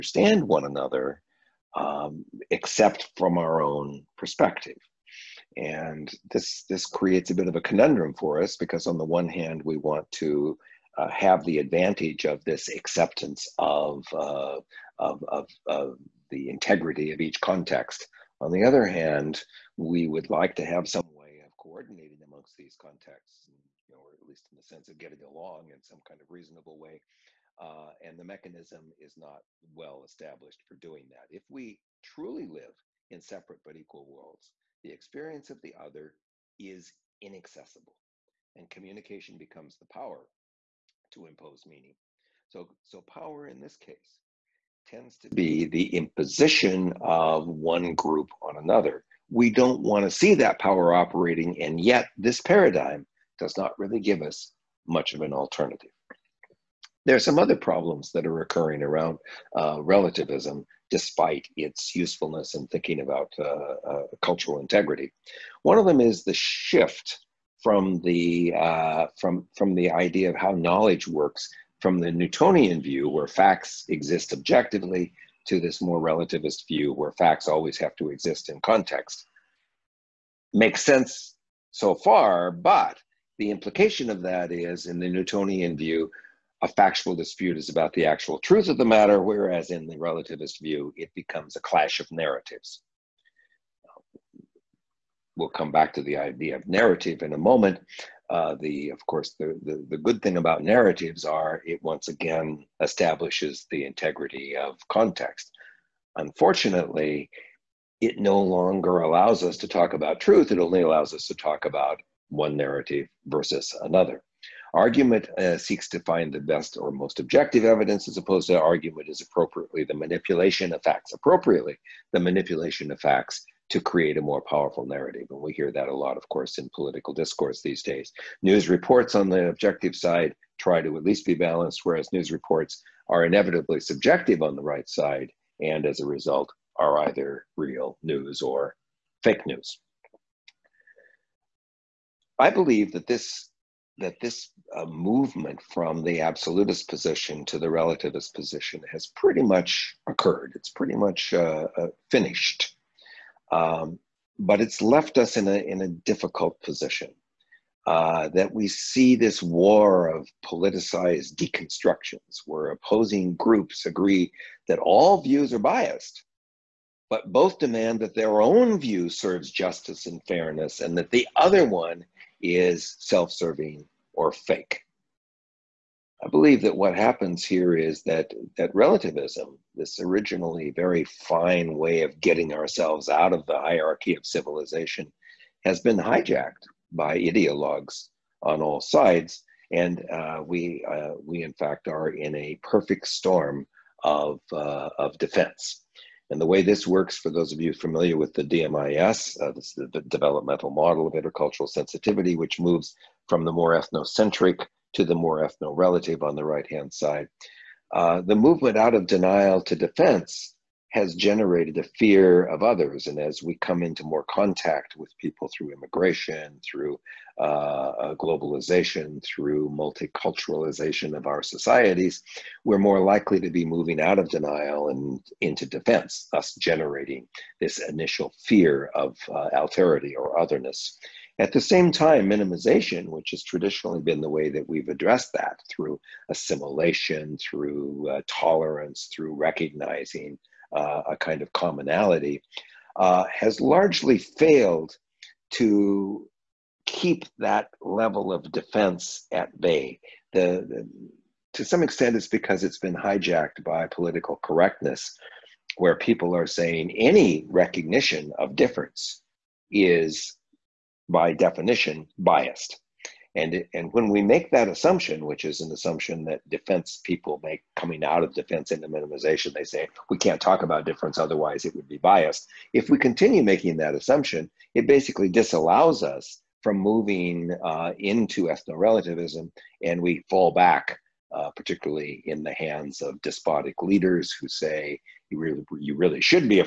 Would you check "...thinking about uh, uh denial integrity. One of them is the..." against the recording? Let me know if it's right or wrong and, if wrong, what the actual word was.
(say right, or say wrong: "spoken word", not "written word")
wrong: "cultural", not "denial".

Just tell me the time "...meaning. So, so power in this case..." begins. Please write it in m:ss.
0:41.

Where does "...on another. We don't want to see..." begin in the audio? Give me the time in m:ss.
0:48.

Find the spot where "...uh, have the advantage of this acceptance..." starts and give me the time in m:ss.
0:10.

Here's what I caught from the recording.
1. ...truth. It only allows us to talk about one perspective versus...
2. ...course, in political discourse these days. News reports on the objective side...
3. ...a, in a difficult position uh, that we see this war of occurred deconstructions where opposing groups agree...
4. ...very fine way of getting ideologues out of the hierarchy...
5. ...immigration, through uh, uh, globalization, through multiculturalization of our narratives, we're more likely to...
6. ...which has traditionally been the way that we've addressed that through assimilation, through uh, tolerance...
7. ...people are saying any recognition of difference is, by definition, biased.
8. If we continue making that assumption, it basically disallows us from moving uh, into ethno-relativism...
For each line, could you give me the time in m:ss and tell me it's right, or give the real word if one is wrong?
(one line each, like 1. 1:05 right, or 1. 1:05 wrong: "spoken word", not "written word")
1. 1:50 wrong: "narrative", not "perspective"
2. 2:06 right
3. 2:35 wrong: "politicized", not "occurred"
4. 3:00 wrong: "ourselves", not "ideologues"
5. 3:35 wrong: "societies", not "narratives"
6. 3:53 right
7. 4:15 right
8. 4:32 right.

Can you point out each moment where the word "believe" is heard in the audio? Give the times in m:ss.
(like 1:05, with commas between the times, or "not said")
2:22, 2:56.